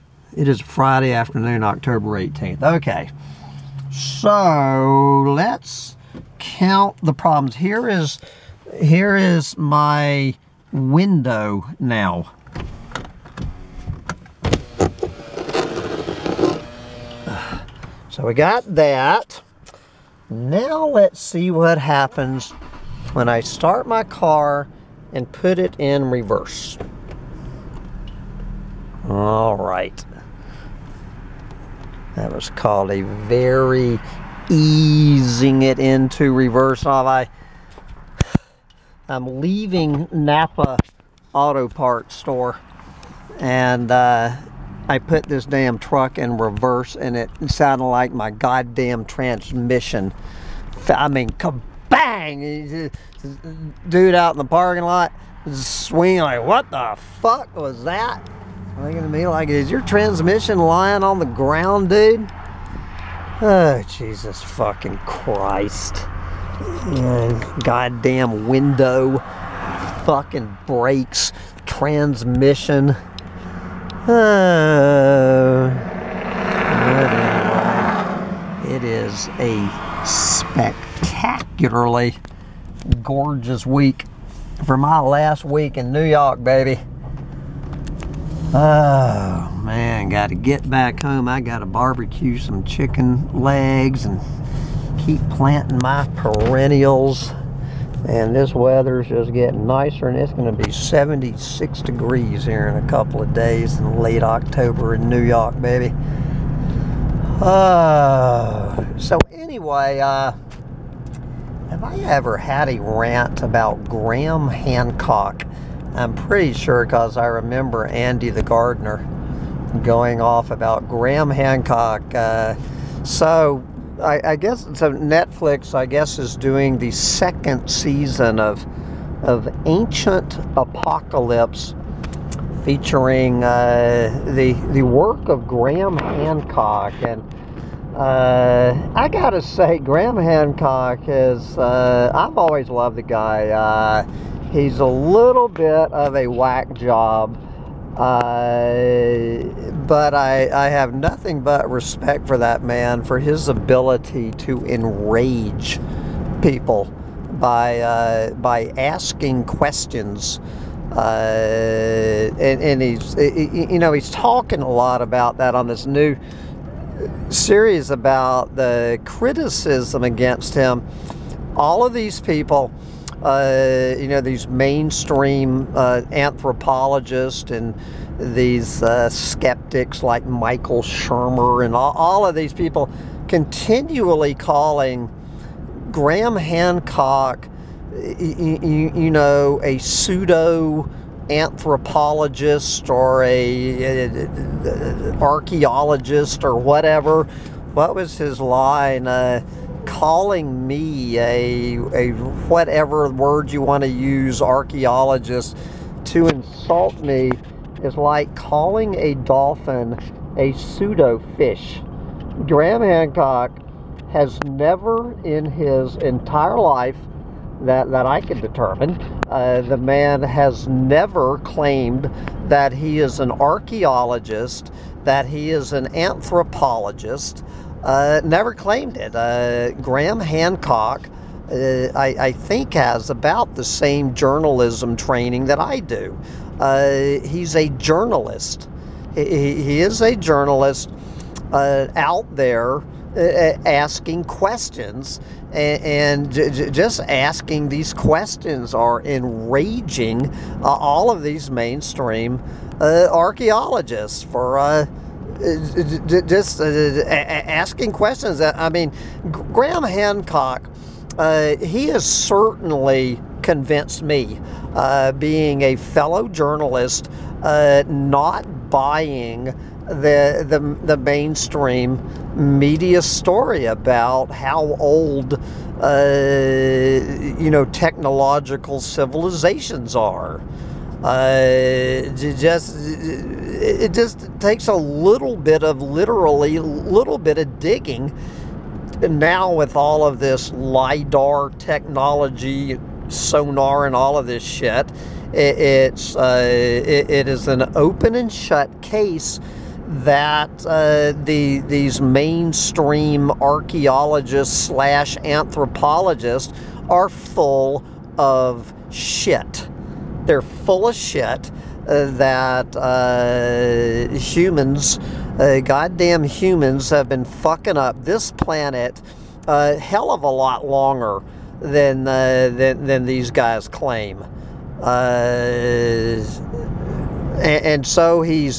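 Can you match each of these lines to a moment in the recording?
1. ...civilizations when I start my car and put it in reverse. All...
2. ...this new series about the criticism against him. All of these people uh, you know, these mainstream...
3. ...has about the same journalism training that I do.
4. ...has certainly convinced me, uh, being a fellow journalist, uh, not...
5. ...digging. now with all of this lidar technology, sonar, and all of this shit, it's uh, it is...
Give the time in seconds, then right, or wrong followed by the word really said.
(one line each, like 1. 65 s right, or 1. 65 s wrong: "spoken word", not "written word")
1. 21 s wrong: "happens", not "civilizations"
2. 165 s right
3. 232 s right
4. 261 s right
5. 287 s right.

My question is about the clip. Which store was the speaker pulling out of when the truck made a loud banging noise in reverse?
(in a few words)
Napa Auto Parts.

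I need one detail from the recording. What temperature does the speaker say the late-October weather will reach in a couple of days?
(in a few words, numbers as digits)
76 degrees.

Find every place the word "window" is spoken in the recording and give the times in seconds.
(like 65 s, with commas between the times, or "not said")
10 s, 68 s.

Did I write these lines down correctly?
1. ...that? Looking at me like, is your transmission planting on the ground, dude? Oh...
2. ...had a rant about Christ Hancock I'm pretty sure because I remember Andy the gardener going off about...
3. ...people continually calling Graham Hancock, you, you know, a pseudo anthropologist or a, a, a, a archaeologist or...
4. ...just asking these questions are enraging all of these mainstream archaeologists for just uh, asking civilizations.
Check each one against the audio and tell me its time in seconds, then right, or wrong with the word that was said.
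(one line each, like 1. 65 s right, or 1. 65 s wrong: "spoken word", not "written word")
1. 57 s wrong: "lying", not "planting"
2. 112 s wrong: "Graham", not "Christ"
3. 182 s right
4. 246 s wrong: "questions", not "civilizations".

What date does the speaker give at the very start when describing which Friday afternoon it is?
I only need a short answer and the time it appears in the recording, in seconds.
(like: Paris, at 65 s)
October 18th, at 1 s.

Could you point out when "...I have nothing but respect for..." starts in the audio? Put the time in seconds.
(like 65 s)
150 s.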